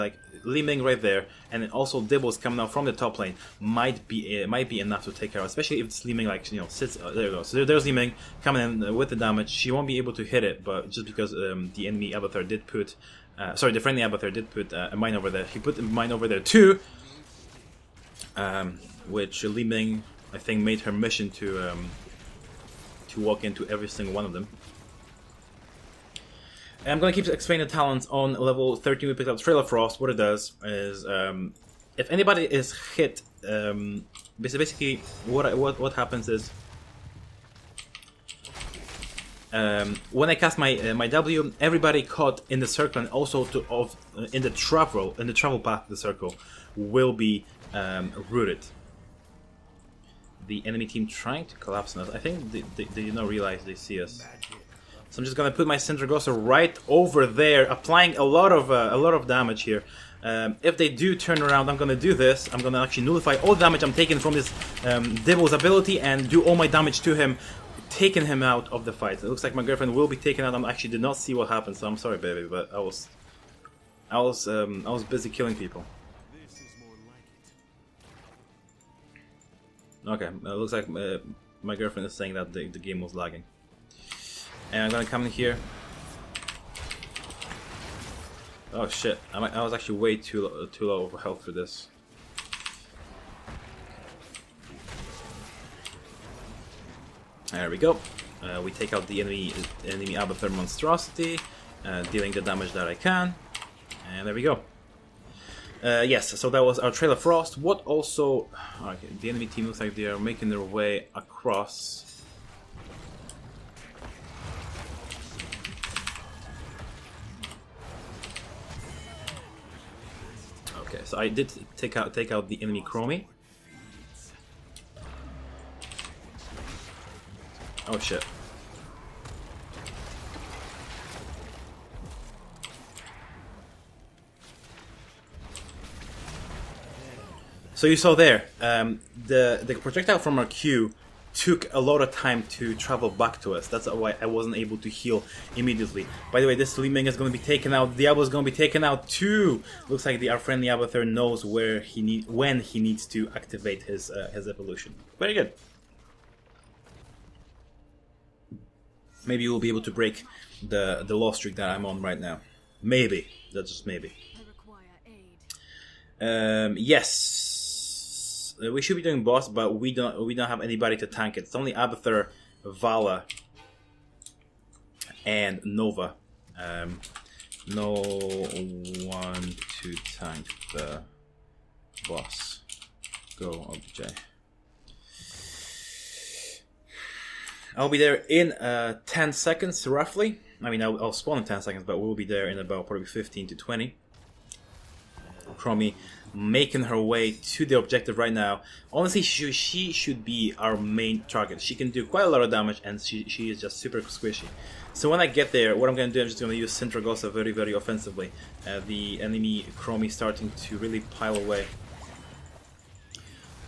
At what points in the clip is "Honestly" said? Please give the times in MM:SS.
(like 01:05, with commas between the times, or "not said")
03:18.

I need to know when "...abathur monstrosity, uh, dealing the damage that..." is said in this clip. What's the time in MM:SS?
01:40.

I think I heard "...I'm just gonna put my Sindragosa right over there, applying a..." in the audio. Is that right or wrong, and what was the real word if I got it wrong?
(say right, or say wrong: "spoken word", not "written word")
right.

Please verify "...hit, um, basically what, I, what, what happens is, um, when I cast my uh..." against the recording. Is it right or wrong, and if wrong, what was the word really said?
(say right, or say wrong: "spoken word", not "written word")
right.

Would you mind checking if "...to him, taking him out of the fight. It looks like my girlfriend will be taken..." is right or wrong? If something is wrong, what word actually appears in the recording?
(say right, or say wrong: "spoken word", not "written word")
right.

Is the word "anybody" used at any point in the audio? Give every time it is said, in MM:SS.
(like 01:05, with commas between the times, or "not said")
00:32, 02:50.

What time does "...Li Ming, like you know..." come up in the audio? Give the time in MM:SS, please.
00:06.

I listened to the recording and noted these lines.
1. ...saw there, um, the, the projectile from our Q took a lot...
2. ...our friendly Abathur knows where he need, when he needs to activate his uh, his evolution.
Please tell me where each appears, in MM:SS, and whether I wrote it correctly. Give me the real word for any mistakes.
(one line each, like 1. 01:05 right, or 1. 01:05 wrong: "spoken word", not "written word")
1. 02:17 right
2. 02:30 right.